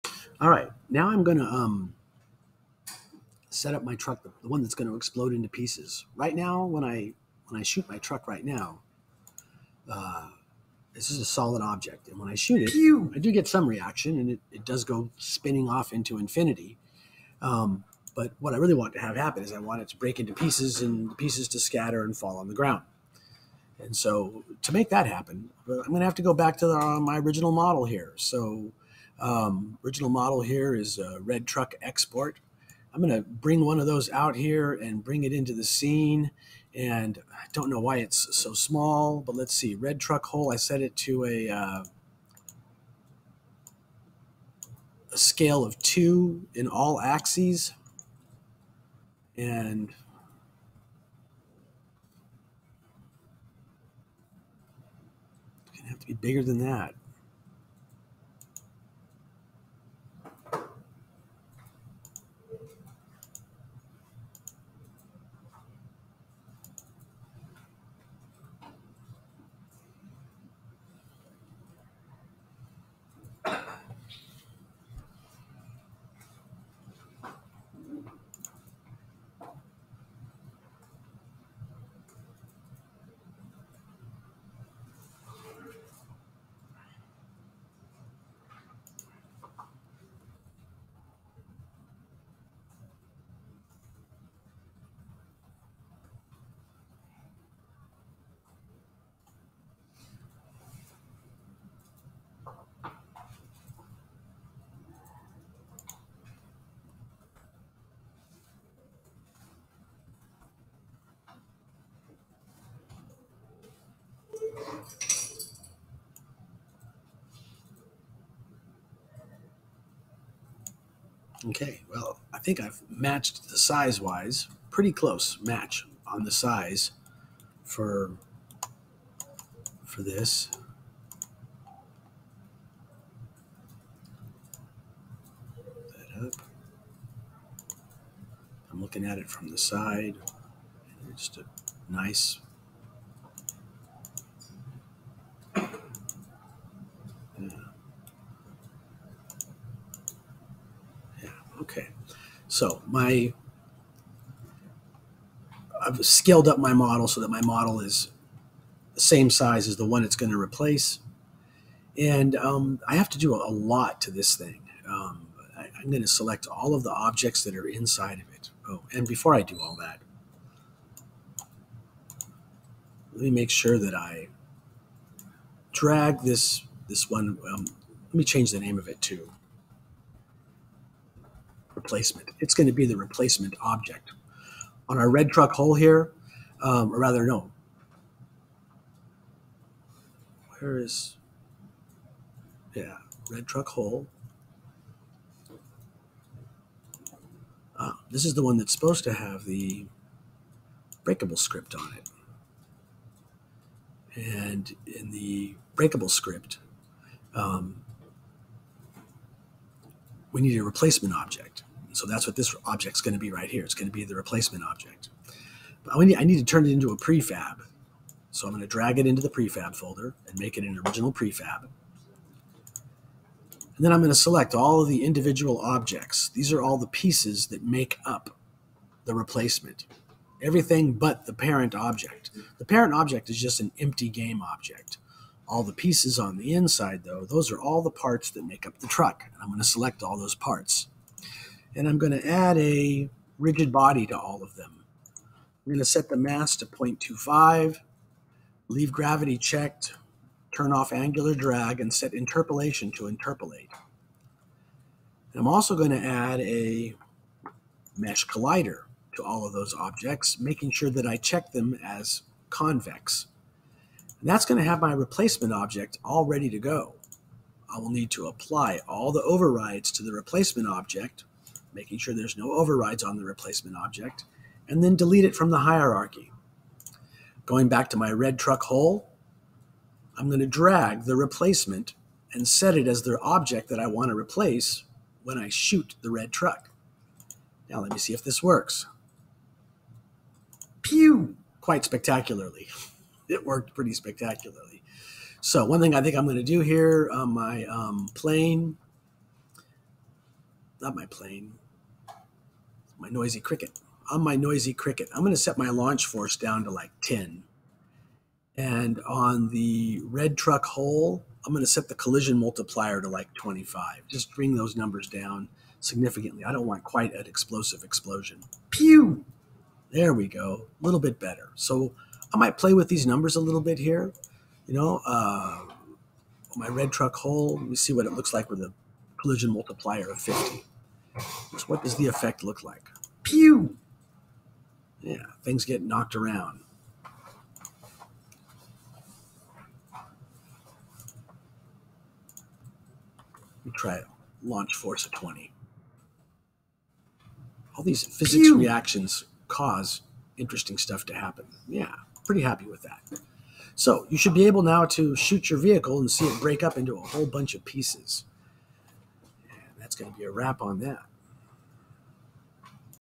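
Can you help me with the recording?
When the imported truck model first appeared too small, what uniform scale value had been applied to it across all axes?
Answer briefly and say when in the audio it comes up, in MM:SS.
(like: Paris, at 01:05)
2, at 00:45.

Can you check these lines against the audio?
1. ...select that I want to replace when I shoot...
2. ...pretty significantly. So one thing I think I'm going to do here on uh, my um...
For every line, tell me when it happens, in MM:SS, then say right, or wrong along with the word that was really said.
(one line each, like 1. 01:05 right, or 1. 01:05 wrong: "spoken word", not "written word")
1. 04:43 wrong: "object", not "select"
2. 04:53 wrong: "spectacularly", not "significantly".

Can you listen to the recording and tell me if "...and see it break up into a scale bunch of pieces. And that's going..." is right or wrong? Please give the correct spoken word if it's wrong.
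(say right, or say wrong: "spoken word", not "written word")
wrong: "whole", not "scale".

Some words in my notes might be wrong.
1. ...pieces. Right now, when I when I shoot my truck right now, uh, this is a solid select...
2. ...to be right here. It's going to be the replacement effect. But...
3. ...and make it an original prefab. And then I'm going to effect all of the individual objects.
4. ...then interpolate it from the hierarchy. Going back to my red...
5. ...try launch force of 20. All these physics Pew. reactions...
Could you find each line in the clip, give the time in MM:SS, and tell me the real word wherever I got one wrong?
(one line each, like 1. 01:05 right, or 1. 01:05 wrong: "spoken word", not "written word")
1. 00:05 wrong: "object", not "select"
2. 03:33 wrong: "object", not "effect"
3. 03:40 wrong: "select", not "effect"
4. 04:34 wrong: "delete", not "interpolate"
5. 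05:43 right.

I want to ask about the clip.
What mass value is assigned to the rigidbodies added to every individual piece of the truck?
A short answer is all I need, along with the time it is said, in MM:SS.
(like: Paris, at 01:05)
0.25, at 04:06.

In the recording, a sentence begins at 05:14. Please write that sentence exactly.
Just bring those numbers down significantly.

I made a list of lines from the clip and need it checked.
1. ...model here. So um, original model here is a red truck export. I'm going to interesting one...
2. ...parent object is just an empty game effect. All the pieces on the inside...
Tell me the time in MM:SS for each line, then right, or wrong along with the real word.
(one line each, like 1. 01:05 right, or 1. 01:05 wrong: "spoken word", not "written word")
1. 00:27 wrong: "bring", not "interesting"
2. 03:52 wrong: "object", not "effect".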